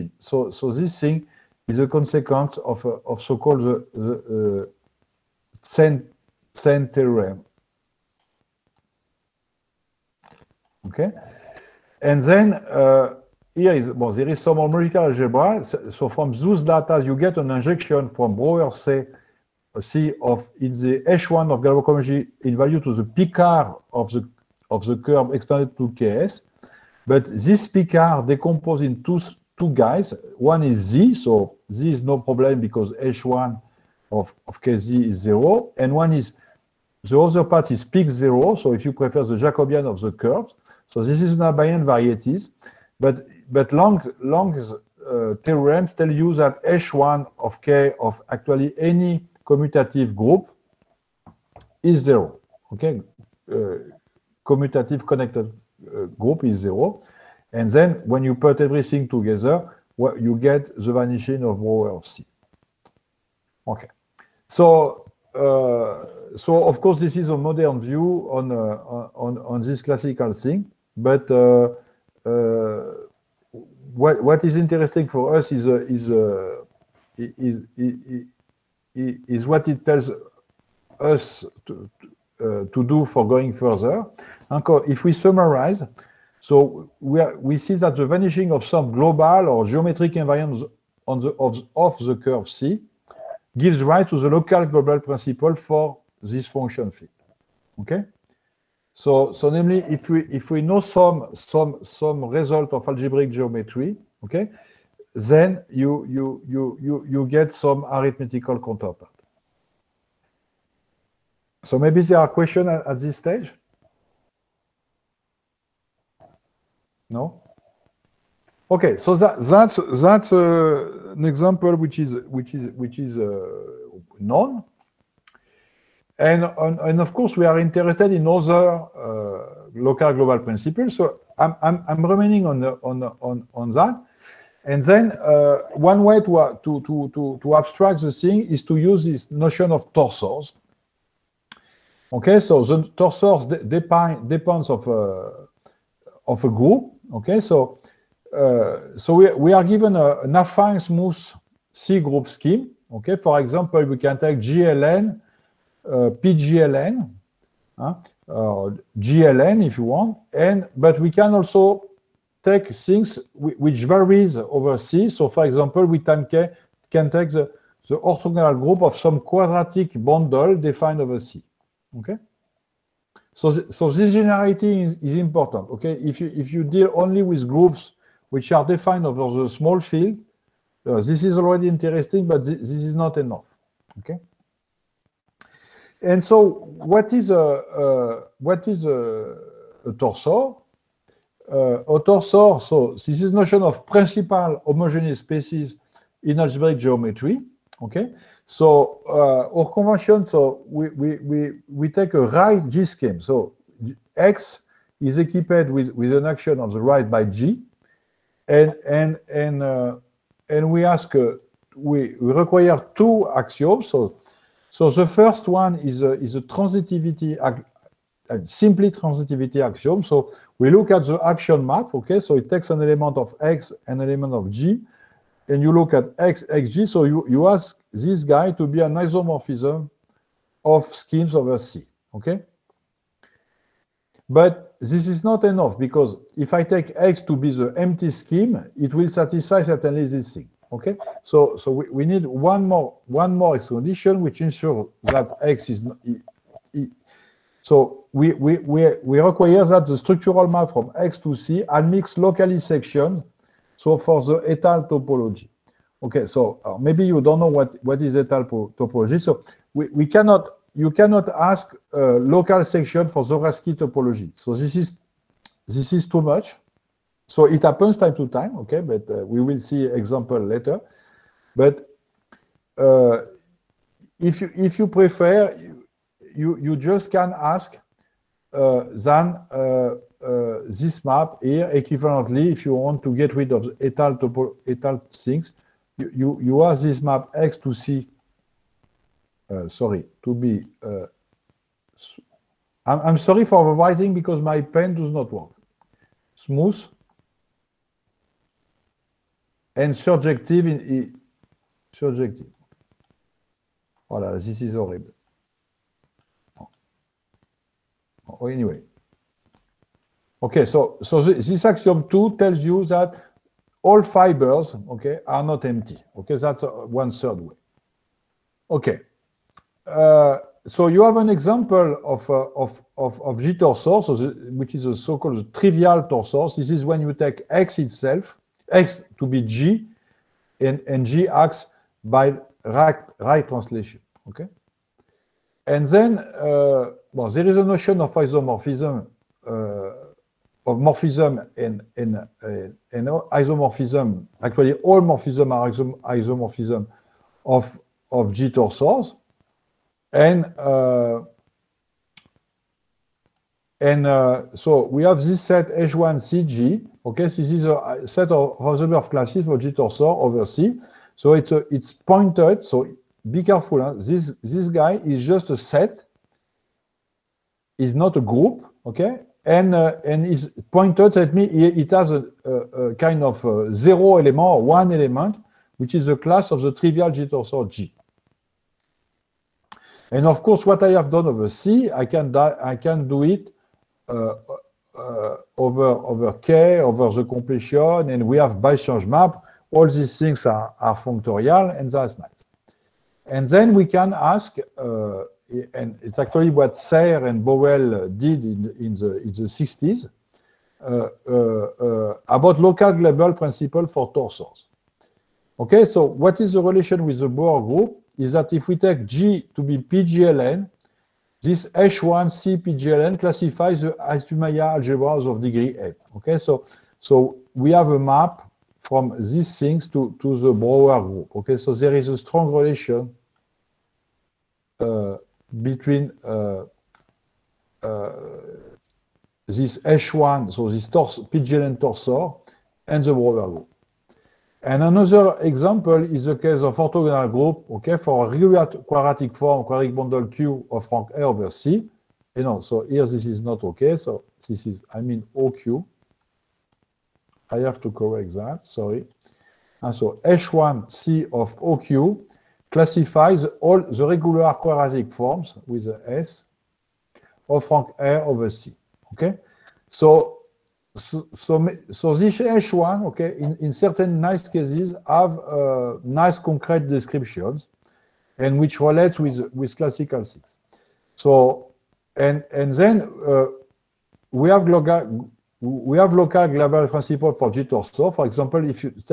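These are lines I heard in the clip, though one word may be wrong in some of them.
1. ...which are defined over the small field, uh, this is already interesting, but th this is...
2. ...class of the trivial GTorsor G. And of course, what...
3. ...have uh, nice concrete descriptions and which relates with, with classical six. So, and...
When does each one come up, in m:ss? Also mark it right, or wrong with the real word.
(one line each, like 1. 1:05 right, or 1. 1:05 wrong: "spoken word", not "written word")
1. 2:58 right
2. 6:16 right
3. 7:45 right.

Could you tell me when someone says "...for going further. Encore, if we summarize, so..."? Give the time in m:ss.
1:23.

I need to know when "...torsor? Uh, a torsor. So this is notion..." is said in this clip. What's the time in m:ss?
3:09.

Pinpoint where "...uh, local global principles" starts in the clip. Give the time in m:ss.
2:08.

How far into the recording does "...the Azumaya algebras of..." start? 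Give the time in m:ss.
6:53.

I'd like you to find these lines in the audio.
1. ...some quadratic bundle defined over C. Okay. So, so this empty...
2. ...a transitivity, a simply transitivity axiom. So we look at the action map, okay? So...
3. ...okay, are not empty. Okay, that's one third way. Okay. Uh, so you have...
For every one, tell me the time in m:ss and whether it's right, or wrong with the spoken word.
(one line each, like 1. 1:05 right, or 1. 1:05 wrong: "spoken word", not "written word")
1. 2:48 wrong: "generality", not "empty"
2. 3:36 right
3. 5:14 right.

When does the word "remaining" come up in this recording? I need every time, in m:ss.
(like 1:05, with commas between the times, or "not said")
2:12.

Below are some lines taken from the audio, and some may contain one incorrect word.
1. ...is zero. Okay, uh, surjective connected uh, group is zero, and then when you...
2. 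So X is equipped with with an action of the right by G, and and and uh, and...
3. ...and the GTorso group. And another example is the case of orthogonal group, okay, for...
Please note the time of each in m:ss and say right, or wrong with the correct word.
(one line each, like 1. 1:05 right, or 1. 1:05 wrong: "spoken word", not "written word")
1. 0:51 wrong: "commutative", not "surjective"
2. 3:23 right
3. 7:12 wrong: "Brauer", not "GTorso".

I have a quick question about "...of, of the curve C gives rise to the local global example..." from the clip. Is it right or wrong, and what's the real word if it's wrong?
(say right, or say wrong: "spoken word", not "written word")
wrong: "principle", not "example".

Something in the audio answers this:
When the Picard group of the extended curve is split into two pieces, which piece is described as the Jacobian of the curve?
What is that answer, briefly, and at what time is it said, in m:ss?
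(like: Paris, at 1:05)
Pic zero, at 0:37.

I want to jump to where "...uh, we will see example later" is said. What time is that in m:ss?
4:29.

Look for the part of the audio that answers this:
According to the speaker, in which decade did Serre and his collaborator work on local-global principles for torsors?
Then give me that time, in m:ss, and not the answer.
6:39.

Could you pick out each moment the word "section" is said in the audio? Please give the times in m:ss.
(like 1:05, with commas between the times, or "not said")
4:12, 4:22.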